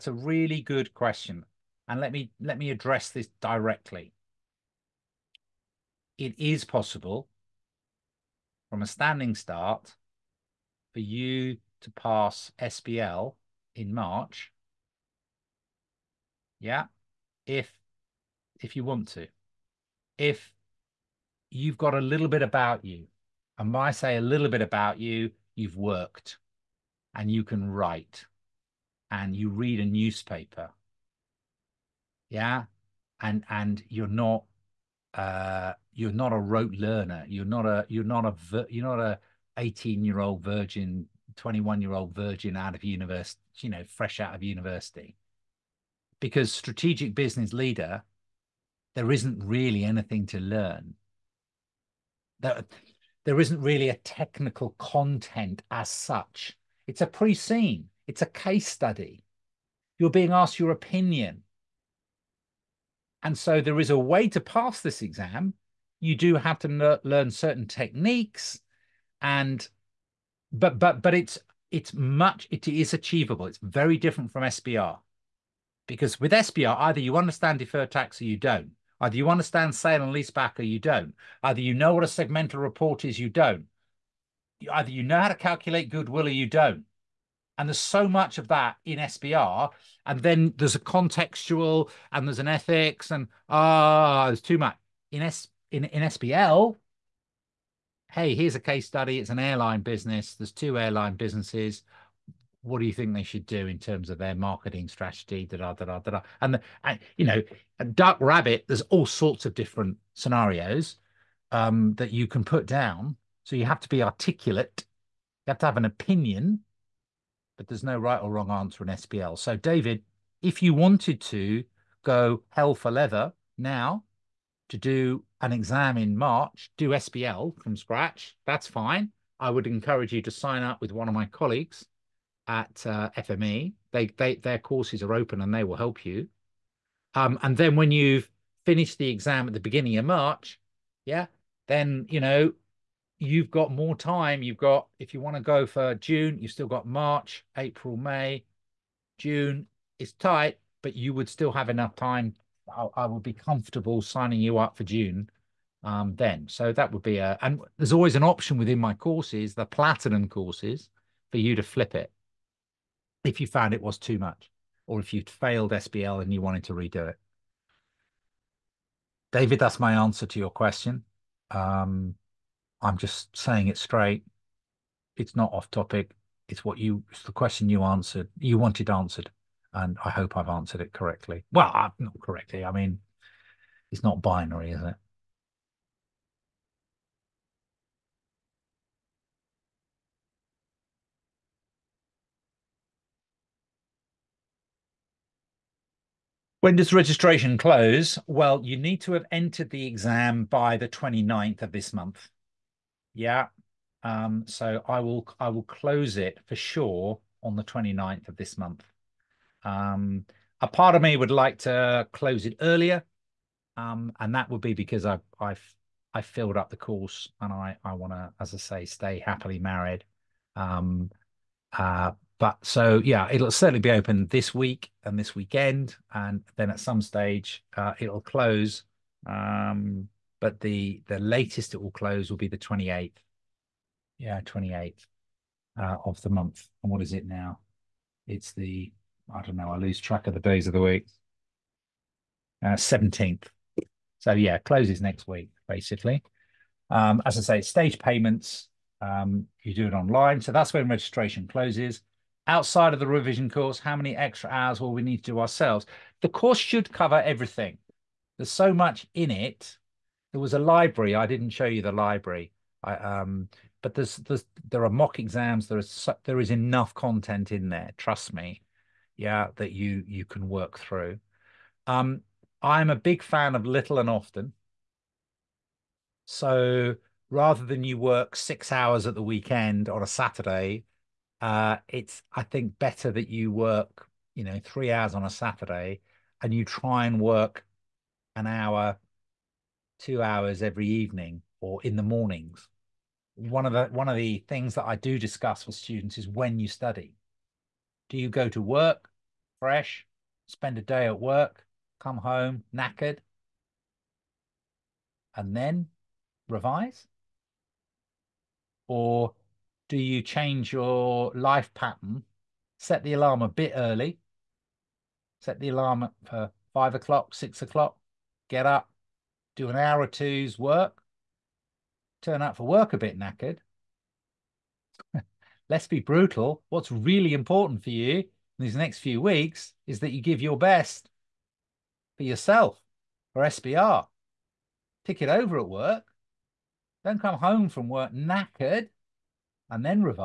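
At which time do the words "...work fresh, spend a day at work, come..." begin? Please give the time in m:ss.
4:58.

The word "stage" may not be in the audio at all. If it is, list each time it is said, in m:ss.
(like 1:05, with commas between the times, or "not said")
3:47, 4:07.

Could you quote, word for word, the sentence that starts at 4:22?
I, um, but there's, there's, there are mock exams.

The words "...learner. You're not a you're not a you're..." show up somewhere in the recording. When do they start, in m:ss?
0:36.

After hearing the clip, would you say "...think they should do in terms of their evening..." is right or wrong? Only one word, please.
wrong.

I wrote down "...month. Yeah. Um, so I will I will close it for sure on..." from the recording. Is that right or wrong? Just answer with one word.
right.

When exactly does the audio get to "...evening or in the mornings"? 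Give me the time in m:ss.
4:50.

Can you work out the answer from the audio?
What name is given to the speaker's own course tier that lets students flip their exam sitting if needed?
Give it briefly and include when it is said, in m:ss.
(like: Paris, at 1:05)
Platinum, at 2:39.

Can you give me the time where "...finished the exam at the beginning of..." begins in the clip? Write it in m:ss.
2:18.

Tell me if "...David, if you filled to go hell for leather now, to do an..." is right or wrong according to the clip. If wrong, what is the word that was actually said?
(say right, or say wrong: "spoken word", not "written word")
wrong: "wanted", not "filled".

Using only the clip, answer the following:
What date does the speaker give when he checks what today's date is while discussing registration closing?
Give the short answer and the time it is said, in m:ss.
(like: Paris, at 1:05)
17th, at 4:02.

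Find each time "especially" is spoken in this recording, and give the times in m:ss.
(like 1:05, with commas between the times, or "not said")
not said.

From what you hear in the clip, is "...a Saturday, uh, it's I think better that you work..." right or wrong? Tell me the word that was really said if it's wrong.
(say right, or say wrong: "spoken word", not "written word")
right.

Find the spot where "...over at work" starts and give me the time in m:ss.
5:35.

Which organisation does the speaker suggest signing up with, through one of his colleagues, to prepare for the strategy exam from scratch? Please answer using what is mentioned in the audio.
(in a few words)
FME.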